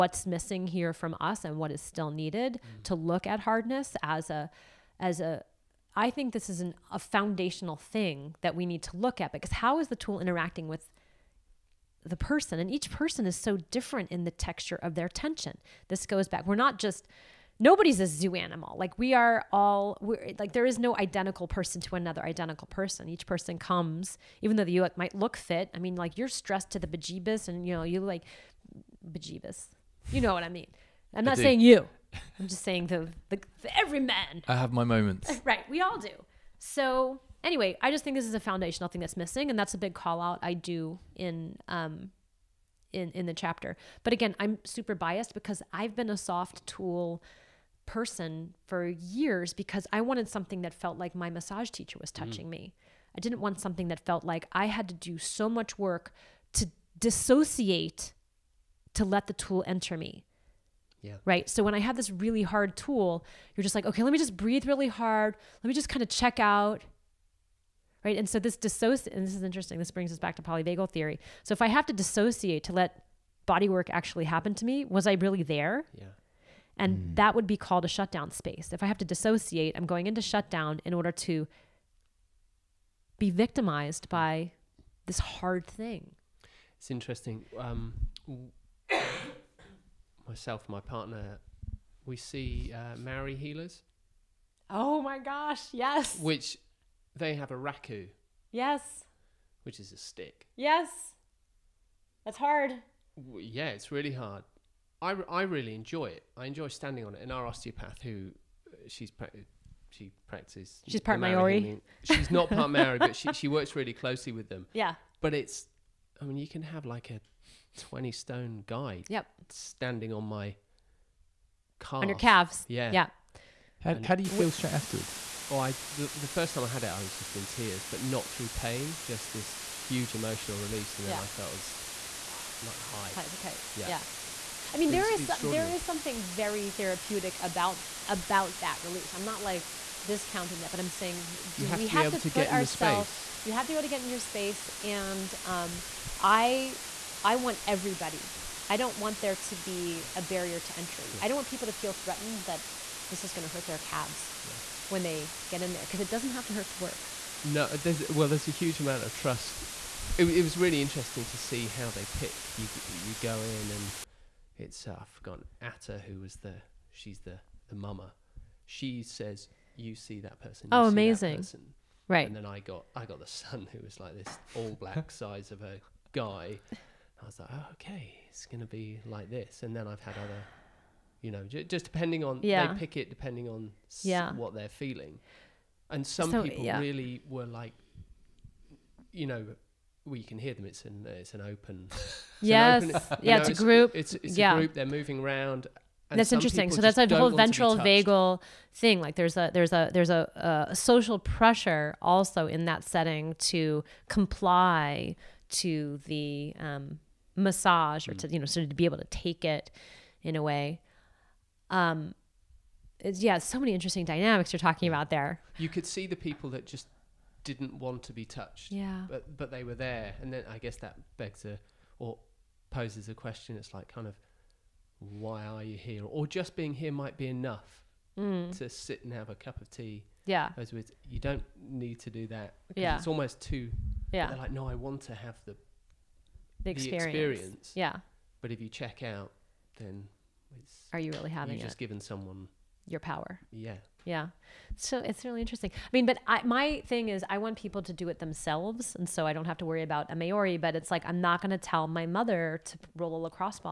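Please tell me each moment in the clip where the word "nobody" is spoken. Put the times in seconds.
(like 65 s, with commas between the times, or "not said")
17 s.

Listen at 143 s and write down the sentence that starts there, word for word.
You have to be able to get in your space, and um, I I want everybody.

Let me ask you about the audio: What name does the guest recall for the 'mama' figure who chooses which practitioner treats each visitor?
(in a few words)
Atta.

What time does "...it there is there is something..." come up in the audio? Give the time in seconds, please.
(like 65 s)
134 s.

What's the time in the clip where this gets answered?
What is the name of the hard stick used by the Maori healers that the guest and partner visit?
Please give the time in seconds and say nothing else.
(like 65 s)
97 s.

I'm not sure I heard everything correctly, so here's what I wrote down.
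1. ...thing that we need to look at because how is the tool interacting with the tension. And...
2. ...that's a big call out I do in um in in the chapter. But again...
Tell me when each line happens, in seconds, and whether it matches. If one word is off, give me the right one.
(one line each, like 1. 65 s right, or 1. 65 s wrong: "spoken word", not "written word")
1. 7 s wrong: "person", not "tension"
2. 39 s right.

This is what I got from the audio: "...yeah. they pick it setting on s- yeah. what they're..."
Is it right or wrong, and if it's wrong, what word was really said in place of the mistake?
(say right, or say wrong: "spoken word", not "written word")
wrong: "depending", not "setting".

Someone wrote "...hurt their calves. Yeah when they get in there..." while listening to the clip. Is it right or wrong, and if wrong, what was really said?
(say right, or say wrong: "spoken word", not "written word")
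right.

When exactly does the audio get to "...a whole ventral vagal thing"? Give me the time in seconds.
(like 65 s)
196 s.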